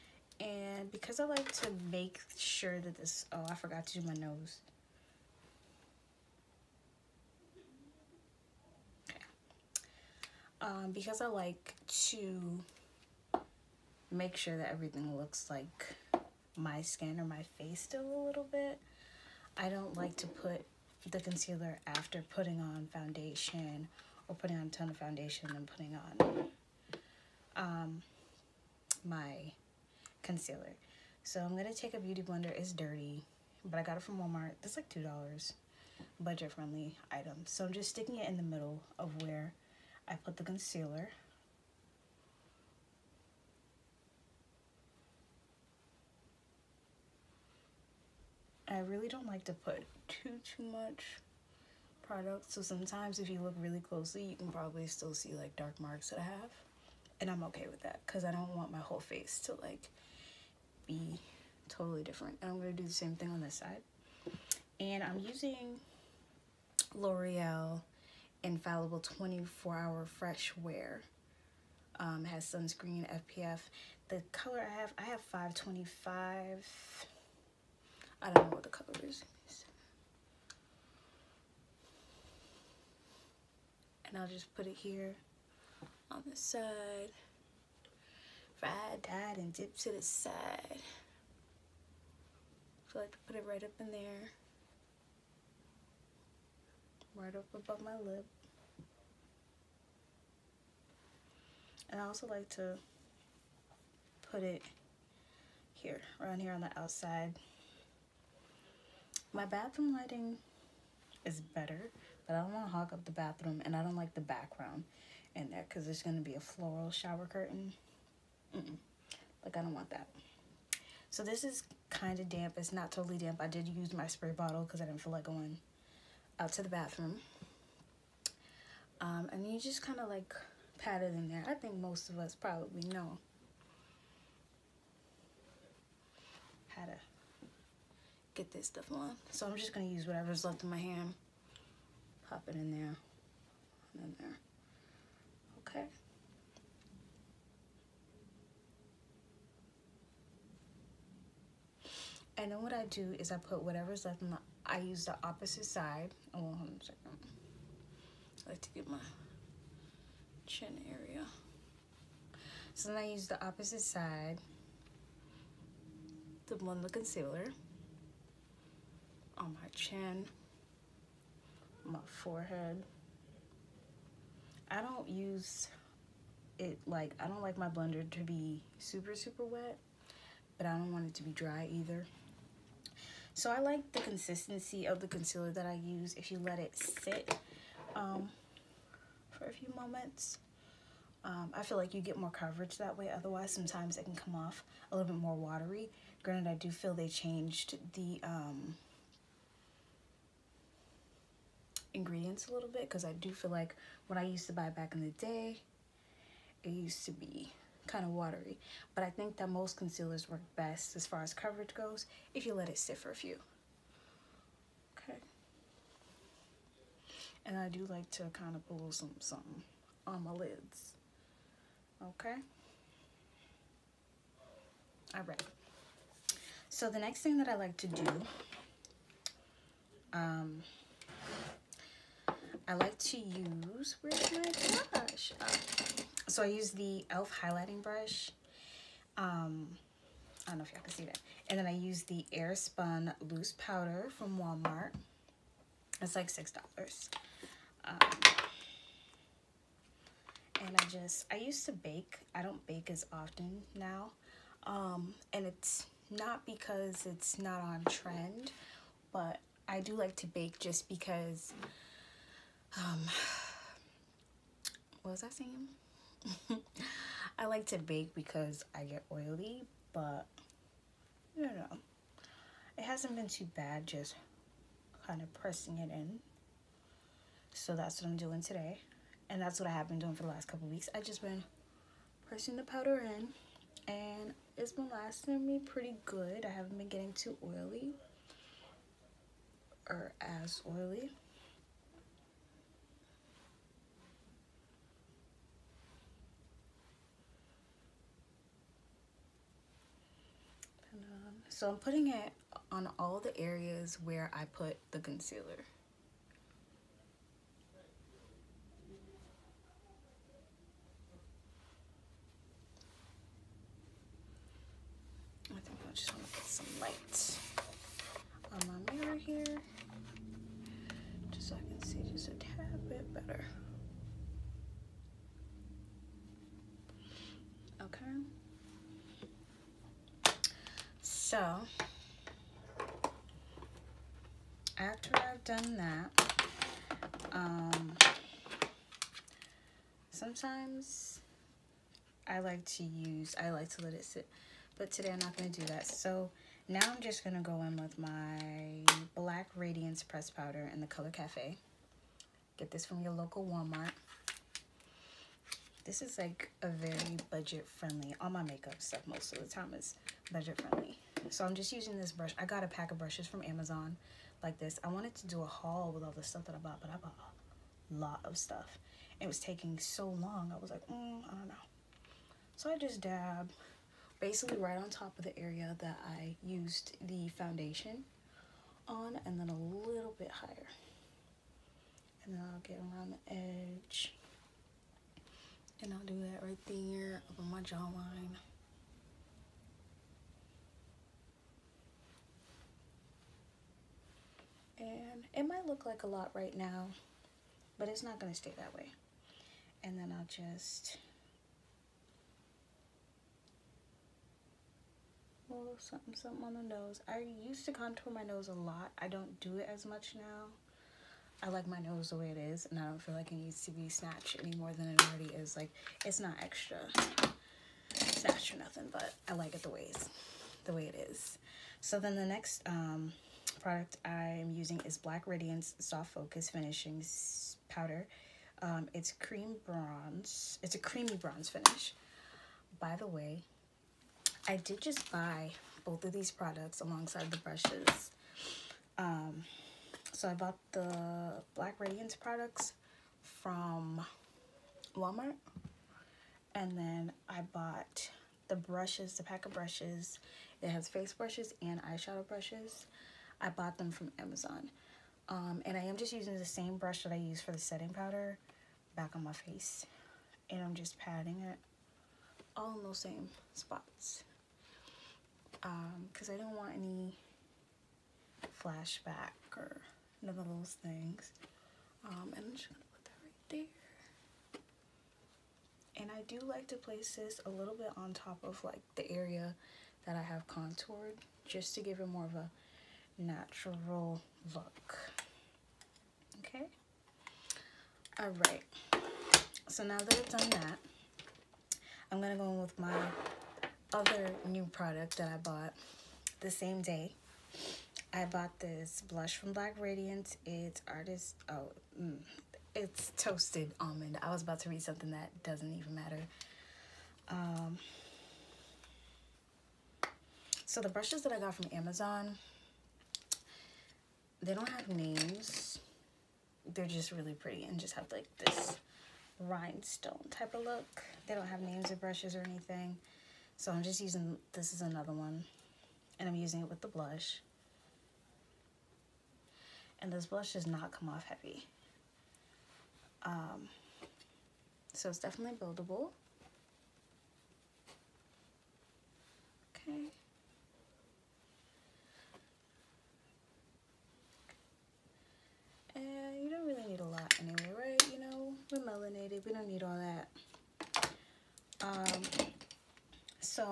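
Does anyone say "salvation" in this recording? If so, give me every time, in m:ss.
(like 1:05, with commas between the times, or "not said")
not said.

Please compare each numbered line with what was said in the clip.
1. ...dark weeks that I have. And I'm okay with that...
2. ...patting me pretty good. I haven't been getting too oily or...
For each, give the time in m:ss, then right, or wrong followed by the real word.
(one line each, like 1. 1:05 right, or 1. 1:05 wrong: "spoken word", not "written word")
1. 0:55 wrong: "marks", not "weeks"
2. 4:44 wrong: "lasting", not "patting".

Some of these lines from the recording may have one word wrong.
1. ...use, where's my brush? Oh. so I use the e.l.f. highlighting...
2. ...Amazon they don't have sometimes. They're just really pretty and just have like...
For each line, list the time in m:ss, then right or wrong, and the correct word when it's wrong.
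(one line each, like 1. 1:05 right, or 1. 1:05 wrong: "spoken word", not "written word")
1. 3:53 right
2. 8:31 wrong: "names", not "sometimes".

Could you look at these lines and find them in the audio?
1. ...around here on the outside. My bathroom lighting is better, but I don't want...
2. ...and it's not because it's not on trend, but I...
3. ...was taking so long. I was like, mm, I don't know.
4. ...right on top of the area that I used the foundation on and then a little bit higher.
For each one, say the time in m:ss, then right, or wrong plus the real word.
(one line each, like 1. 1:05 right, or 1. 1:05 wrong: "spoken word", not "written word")
1. 1:46 right
2. 4:15 right
3. 6:09 right
4. 6:14 right.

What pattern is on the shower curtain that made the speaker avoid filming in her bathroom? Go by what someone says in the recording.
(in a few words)
Floral.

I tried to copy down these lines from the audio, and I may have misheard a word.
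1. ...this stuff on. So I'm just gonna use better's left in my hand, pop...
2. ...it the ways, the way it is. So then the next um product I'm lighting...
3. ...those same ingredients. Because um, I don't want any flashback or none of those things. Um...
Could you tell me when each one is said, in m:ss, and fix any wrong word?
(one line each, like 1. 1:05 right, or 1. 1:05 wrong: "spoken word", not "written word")
1. 2:18 wrong: "whatever", not "better"
2. 6:59 wrong: "using", not "lighting"
3. 7:42 wrong: "spots", not "ingredients".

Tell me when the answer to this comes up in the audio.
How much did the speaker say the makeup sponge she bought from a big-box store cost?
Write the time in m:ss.
0:34.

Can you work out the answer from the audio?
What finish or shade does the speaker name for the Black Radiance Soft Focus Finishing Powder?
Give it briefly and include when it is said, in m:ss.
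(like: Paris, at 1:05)
Cream bronze, at 7:09.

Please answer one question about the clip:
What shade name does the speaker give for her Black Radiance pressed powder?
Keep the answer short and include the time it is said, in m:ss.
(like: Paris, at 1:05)
Cafe, at 5:51.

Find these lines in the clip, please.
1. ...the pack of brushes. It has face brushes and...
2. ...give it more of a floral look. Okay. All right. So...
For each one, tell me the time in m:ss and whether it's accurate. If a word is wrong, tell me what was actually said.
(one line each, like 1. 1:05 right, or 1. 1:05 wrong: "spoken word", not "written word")
1. 7:29 right
2. 8:01 wrong: "natural", not "floral".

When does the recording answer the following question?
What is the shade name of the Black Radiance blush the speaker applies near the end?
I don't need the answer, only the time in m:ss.
8:23.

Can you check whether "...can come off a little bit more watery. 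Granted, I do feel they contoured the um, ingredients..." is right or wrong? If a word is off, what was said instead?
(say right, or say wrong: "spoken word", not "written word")
wrong: "changed", not "contoured".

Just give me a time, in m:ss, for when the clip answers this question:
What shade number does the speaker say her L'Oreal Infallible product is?
1:15.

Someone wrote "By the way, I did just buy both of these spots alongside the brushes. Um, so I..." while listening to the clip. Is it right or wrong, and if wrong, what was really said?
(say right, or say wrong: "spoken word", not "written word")
wrong: "products", not "spots".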